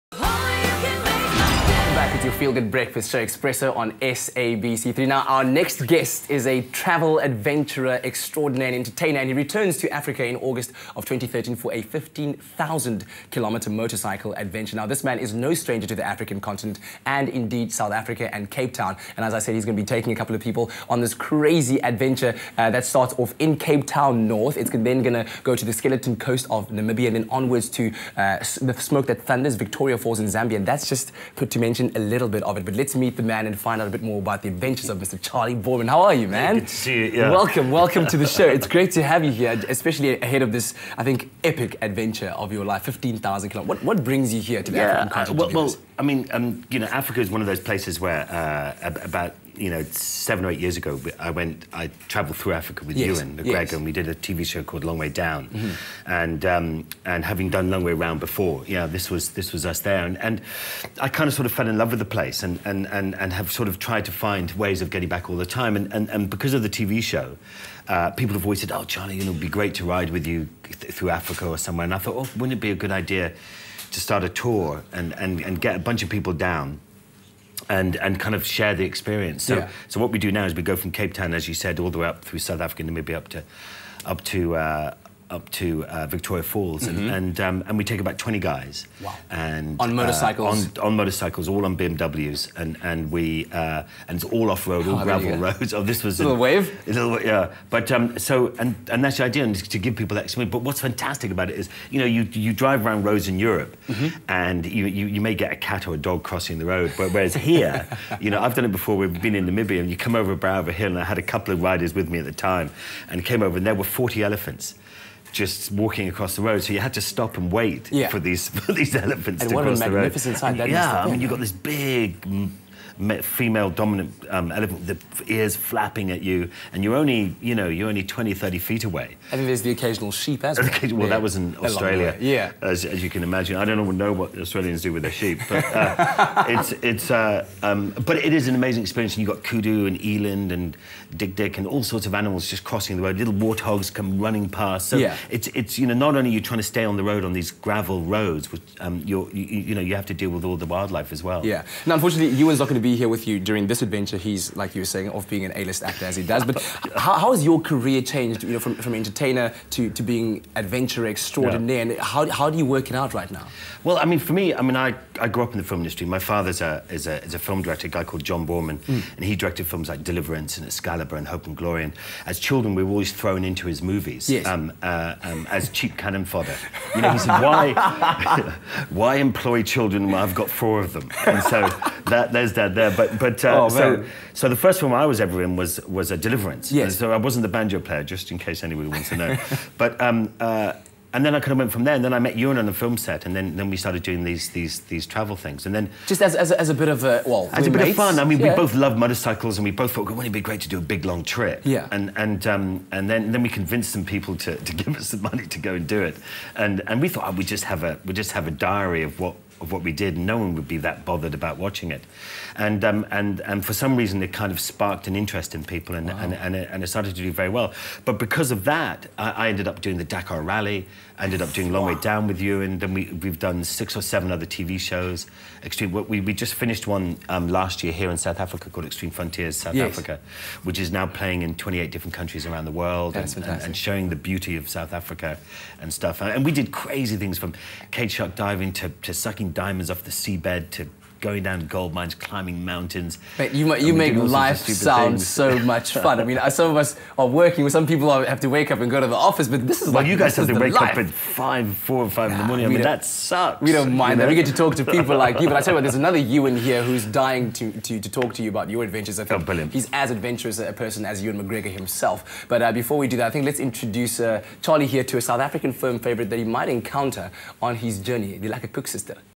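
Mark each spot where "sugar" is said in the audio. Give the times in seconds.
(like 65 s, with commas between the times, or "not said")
not said.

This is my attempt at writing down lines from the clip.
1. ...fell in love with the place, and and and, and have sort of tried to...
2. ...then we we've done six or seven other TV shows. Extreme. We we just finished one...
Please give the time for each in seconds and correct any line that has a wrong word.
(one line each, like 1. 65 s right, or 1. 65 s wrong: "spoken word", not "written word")
1. 61 s right
2. 222 s right.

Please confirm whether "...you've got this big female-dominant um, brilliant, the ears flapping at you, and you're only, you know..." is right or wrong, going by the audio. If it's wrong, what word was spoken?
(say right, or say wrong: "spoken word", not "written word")
wrong: "elephant", not "brilliant".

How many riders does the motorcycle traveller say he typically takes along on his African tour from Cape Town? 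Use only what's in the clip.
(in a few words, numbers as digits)
20.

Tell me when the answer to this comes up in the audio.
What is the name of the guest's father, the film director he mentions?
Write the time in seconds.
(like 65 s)
168 s.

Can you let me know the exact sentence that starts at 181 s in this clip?
And so that, there's that there.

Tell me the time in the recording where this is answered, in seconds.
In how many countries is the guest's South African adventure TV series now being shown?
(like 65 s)
231 s.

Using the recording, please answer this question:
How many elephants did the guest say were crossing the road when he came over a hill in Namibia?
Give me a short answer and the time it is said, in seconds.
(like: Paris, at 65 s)
40, at 113 s.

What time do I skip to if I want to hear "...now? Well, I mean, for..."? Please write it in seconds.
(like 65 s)
163 s.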